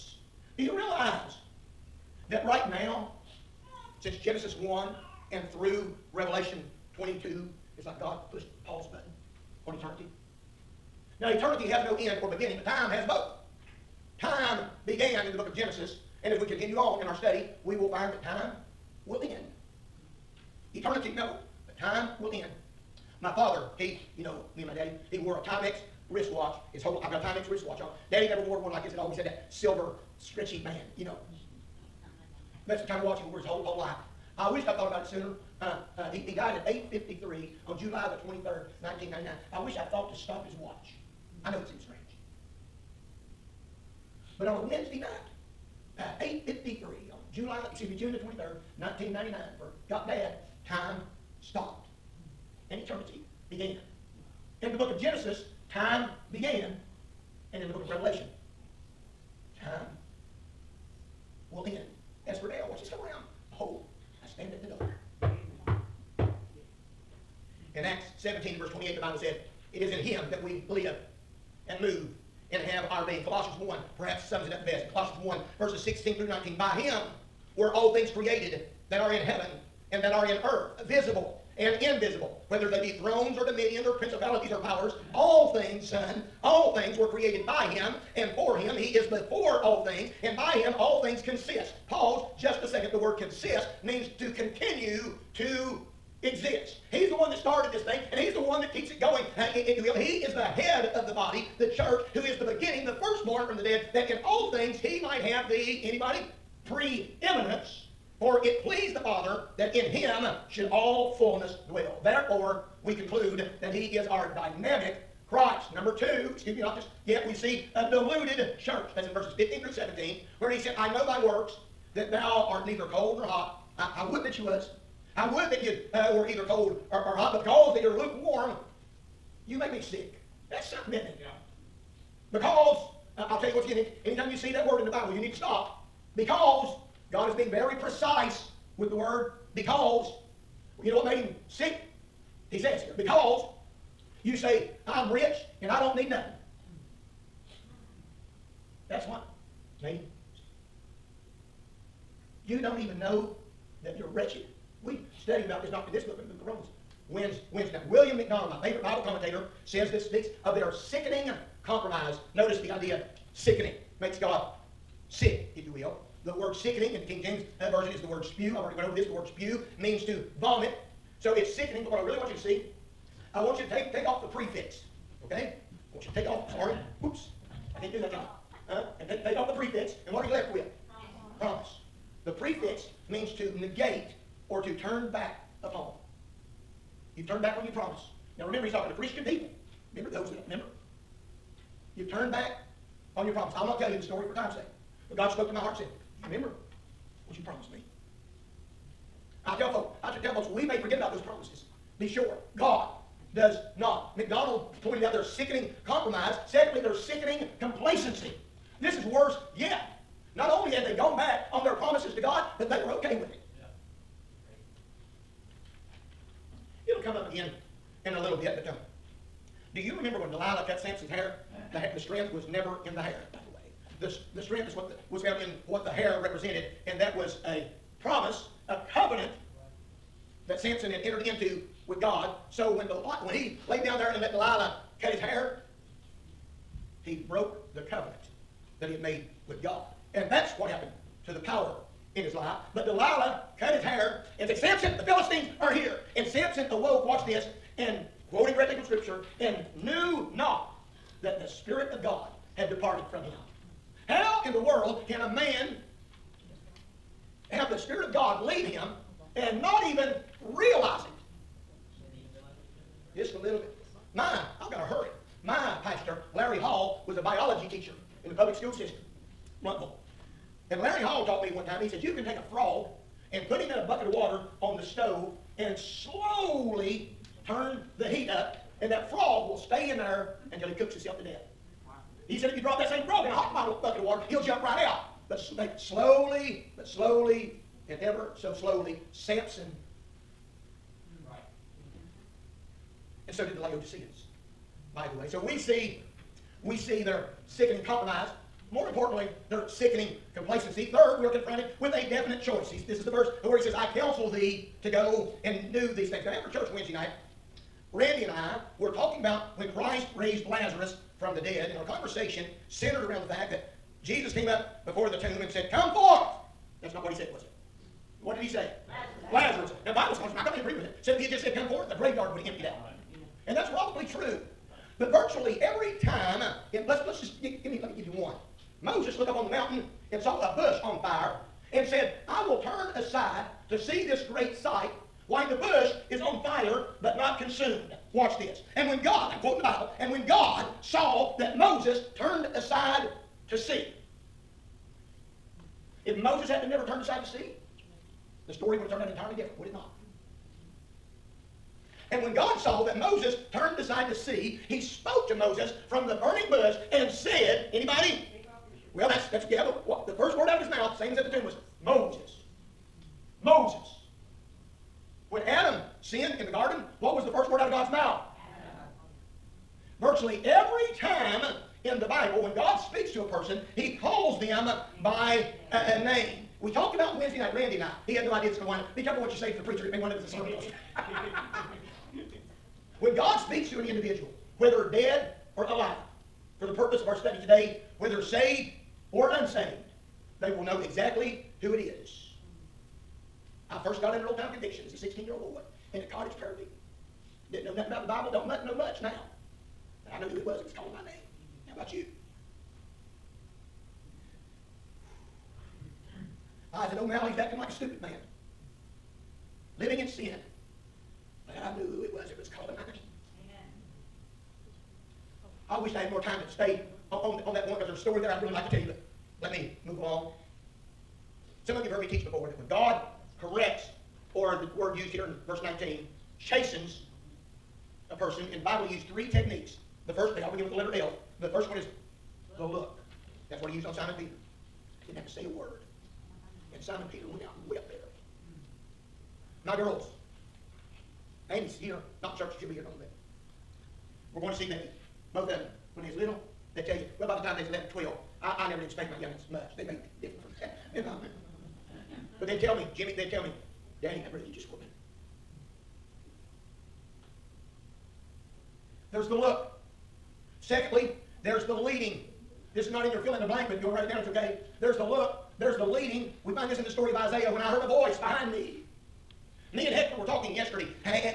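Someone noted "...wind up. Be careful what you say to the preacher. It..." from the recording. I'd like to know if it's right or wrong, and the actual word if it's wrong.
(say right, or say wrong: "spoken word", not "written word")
right.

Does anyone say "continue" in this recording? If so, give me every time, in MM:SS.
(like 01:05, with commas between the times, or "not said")
00:16, 01:34.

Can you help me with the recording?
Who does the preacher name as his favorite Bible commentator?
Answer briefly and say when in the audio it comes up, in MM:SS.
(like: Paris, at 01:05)
William MacDonald, at 02:37.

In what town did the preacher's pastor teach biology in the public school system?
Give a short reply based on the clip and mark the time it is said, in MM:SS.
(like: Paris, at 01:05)
Blountville, at 04:29.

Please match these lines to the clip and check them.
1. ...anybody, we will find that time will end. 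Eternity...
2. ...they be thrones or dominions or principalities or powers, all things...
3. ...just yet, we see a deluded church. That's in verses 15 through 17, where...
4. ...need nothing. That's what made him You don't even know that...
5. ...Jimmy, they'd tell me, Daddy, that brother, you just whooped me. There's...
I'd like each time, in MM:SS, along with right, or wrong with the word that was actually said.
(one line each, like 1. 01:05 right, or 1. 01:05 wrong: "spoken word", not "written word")
1. 00:17 wrong: "study", not "anybody"
2. 01:22 right
3. 01:56 right
4. 02:25 right
5. 07:32 right.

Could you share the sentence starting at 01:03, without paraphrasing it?
Behold, I stand at the door.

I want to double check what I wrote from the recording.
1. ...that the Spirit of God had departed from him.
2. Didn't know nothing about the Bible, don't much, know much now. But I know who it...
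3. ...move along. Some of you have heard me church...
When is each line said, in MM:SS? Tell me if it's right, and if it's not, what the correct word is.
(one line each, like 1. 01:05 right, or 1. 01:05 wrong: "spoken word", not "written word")
1. 04:11 right
2. 06:37 right
3. 06:59 wrong: "teach", not "church".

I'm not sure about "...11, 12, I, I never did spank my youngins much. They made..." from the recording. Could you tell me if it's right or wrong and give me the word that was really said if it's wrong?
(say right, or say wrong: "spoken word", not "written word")
right.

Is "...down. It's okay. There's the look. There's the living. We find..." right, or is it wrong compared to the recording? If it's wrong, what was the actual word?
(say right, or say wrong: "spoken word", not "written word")
wrong: "leading", not "living".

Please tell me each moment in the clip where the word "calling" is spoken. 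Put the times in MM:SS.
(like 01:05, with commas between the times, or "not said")
06:40, 06:52.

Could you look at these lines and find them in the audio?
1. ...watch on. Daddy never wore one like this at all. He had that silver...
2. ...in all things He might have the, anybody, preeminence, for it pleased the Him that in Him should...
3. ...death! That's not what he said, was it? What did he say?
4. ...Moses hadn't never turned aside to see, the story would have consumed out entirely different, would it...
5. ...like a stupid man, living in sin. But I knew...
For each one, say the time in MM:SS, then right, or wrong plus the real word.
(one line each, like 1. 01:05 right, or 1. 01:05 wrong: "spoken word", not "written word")
1. 00:27 wrong: "wristwatch", not "watch"
2. 01:44 wrong: "Father", not "Him"
3. 05:15 wrong: "forth", not "death"
4. 05:46 wrong: "turned", not "consumed"
5. 06:47 right.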